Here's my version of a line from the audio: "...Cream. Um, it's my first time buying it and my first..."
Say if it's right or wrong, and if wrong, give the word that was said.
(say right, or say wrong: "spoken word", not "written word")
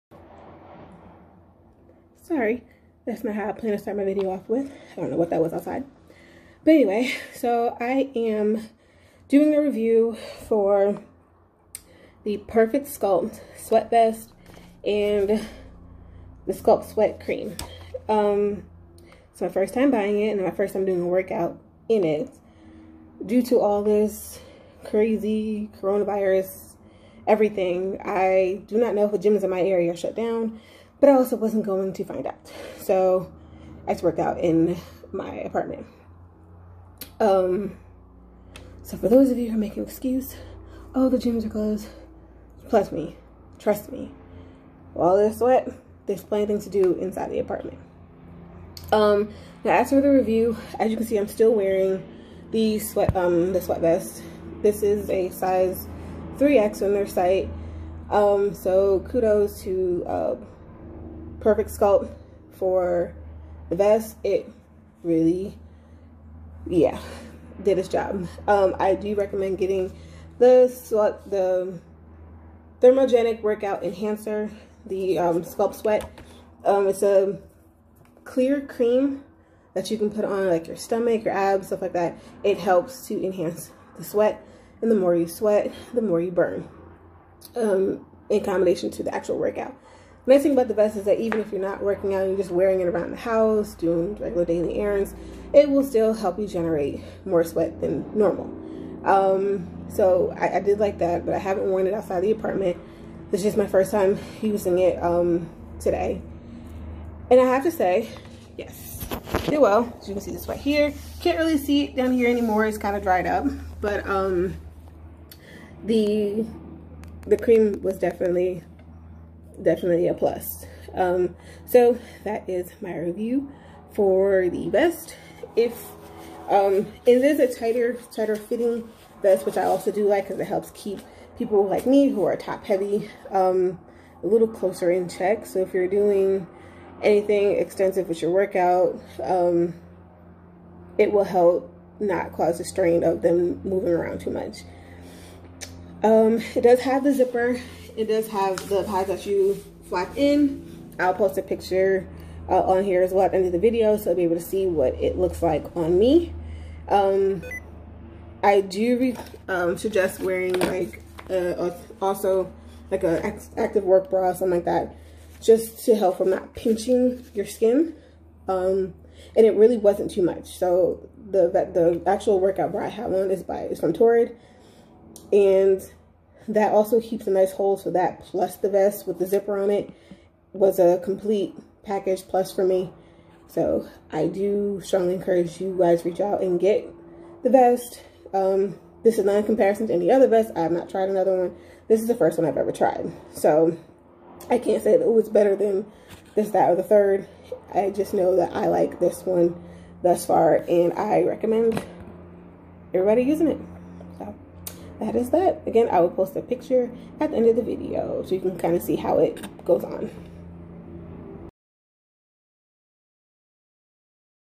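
right.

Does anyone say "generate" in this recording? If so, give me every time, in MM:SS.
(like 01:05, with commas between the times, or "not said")
01:36.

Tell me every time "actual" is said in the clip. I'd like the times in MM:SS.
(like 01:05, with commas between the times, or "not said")
01:29, 02:52.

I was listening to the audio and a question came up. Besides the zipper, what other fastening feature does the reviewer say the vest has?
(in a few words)
pads.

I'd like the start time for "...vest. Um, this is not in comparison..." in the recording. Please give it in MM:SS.
03:07.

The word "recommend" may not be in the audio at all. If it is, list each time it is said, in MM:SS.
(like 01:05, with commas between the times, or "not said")
01:09, 03:21.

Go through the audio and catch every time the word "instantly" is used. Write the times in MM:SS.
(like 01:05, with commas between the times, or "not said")
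not said.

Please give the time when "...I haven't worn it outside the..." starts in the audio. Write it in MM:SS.
01:41.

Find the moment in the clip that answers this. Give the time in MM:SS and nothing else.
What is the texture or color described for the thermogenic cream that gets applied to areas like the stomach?
01:18.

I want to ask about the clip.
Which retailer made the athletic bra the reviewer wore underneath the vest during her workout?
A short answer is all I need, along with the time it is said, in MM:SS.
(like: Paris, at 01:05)
Torrid, at 02:53.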